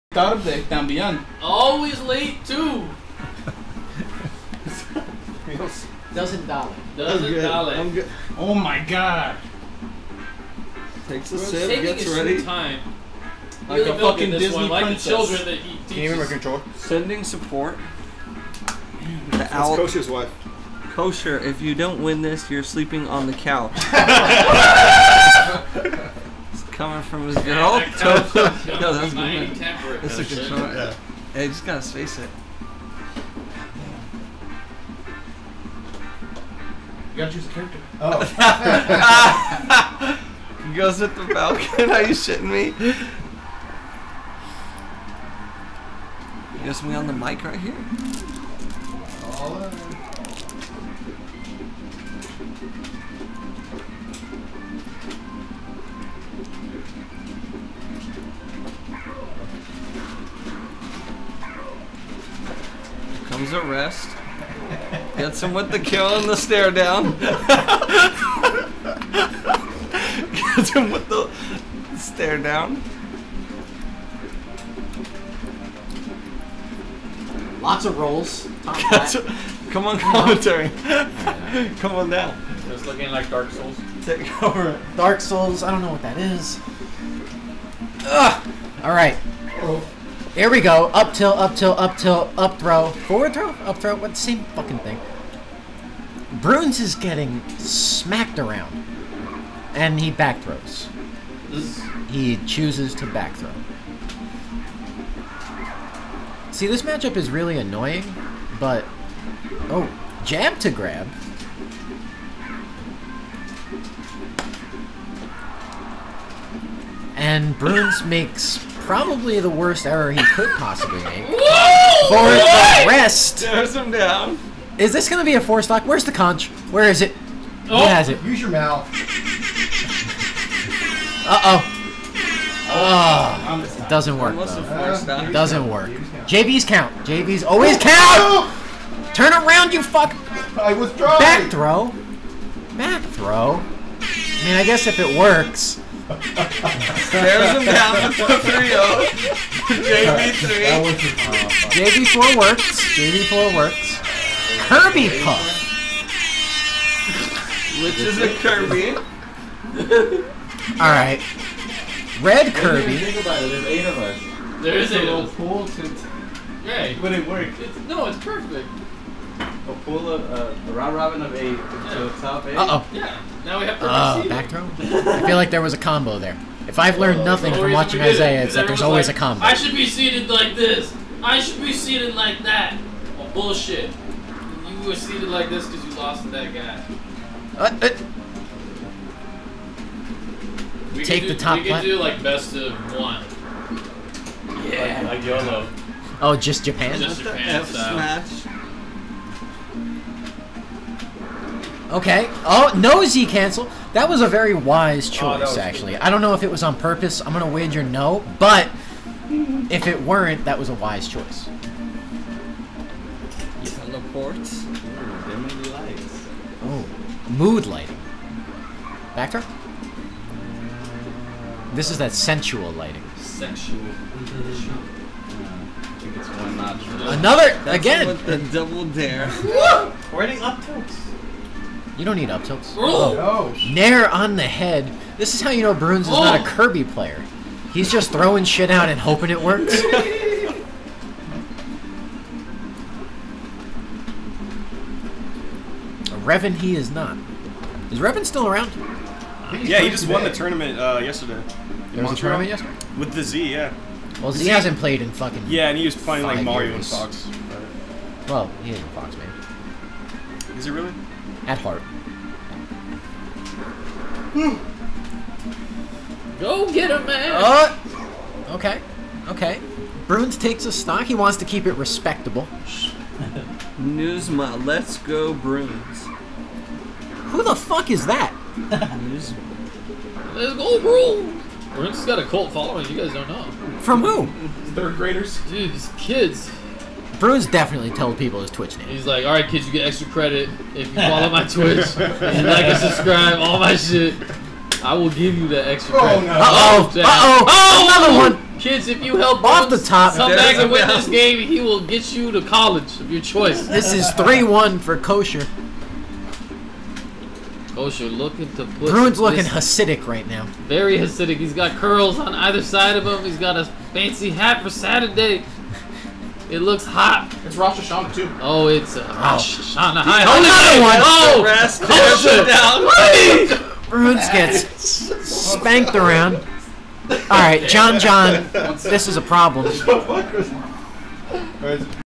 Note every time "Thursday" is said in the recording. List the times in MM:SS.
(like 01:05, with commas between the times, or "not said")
not said.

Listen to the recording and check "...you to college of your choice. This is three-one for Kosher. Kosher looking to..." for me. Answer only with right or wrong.
right.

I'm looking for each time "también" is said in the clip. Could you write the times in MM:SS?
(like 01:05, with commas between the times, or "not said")
00:00.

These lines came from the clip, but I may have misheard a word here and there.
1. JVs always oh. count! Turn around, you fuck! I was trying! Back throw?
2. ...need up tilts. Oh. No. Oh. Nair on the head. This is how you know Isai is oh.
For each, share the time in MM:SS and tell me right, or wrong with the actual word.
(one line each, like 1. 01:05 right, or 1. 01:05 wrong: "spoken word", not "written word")
1. 02:17 right
2. 03:52 wrong: "Broonz", not "Isai".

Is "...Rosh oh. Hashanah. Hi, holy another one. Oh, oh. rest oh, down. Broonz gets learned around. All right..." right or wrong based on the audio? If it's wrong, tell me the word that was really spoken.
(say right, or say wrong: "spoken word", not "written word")
wrong: "spanked", not "learned".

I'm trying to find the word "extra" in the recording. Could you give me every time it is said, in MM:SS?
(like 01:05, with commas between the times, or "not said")
04:49, 04:55.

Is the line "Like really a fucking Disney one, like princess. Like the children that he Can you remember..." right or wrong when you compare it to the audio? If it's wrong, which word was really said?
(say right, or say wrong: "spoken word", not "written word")
right.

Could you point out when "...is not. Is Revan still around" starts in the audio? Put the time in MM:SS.
04:06.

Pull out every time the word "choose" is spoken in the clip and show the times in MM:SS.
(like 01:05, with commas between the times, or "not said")
00:37, 01:42.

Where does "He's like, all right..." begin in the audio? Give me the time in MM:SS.
04:48.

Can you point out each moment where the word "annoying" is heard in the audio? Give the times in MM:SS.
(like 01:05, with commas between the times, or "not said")
01:47.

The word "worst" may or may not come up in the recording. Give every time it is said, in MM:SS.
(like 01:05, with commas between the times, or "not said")
01:59.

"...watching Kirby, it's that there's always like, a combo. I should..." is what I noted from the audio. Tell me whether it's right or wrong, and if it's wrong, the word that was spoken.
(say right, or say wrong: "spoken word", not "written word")
wrong: "Isai", not "Kirby".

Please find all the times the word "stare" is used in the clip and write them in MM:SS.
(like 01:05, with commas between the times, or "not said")
01:06, 01:11, 02:26.